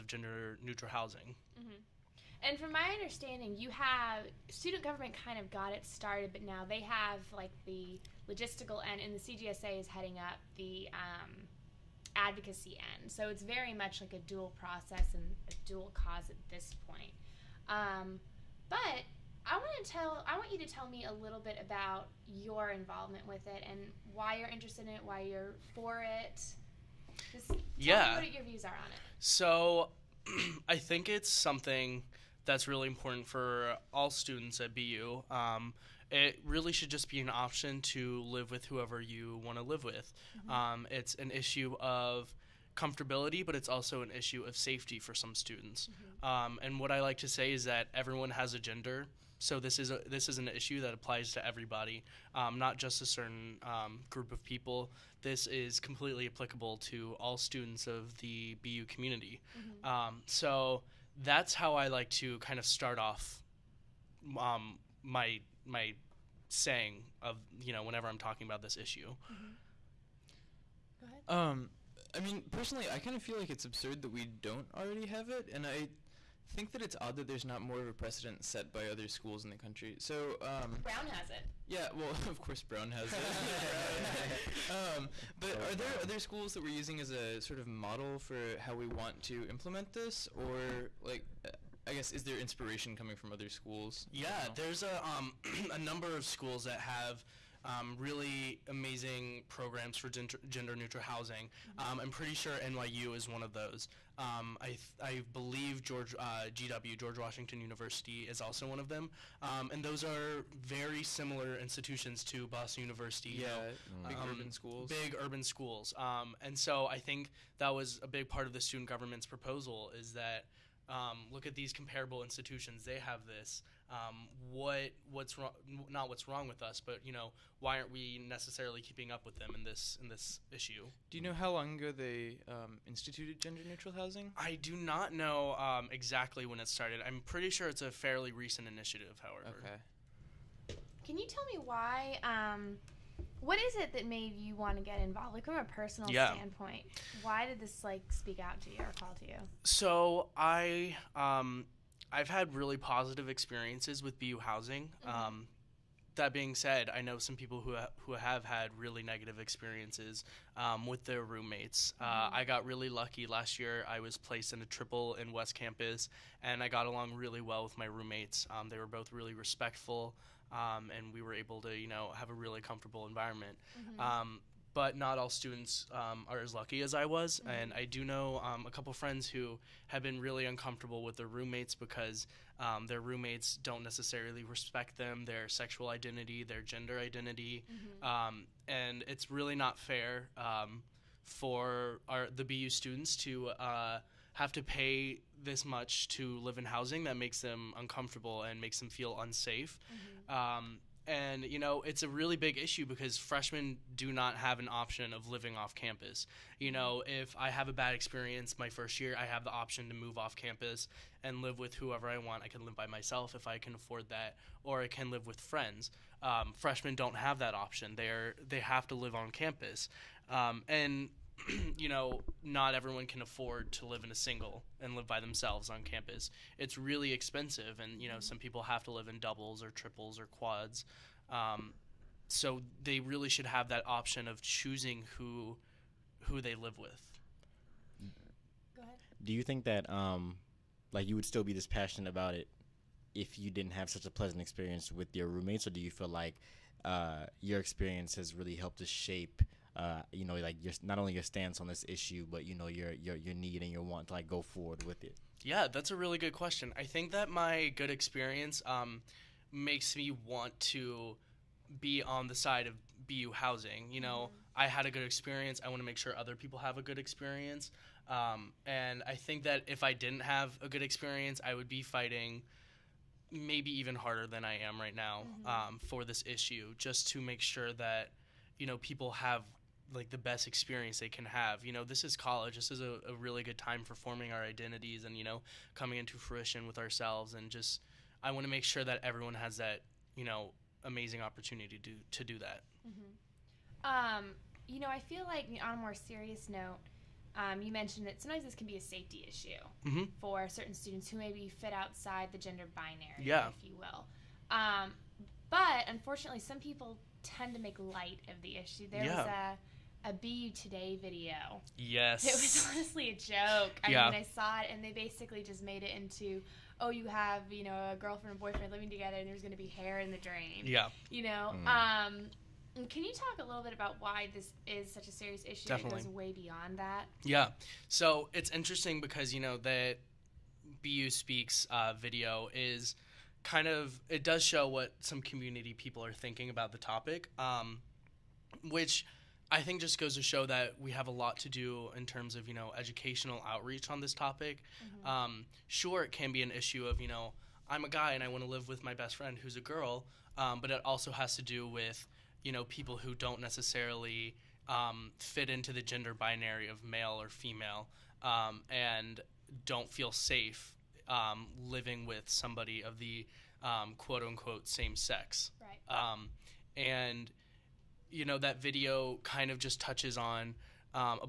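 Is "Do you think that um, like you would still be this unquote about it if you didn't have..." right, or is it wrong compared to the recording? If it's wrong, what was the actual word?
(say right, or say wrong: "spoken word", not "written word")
wrong: "passionate", not "unquote".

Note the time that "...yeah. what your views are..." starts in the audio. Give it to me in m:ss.
0:27.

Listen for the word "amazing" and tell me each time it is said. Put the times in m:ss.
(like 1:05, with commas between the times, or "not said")
1:38, 4:50.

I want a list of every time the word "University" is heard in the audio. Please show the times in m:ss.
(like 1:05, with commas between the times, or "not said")
1:47, 1:52.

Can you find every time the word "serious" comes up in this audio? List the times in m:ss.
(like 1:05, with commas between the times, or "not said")
4:55, 5:25.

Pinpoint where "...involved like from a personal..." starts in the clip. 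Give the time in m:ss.
2:25.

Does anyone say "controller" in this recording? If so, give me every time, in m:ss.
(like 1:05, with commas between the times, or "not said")
not said.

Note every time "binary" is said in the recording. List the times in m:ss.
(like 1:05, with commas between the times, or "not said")
5:02, 5:56.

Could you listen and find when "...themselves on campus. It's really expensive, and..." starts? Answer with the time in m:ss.
3:45.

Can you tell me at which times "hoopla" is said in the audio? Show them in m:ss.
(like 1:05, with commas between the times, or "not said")
not said.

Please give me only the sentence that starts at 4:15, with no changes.
Yeah, that's a really good question.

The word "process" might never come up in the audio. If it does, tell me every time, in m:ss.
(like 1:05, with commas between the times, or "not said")
0:14.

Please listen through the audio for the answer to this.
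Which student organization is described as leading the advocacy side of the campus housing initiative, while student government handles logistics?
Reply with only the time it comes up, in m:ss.
0:09.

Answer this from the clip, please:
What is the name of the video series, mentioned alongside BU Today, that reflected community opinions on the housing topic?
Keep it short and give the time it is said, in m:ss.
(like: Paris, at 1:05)
BU Speaks, at 5:30.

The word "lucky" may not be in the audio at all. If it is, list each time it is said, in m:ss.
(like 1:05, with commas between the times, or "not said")
2:42, 2:56.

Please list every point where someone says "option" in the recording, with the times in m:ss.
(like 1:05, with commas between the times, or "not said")
0:37, 3:24, 3:29, 3:37, 3:53.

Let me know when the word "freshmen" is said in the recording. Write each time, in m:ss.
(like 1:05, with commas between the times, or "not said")
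3:23, 3:36.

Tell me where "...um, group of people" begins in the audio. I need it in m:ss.
0:53.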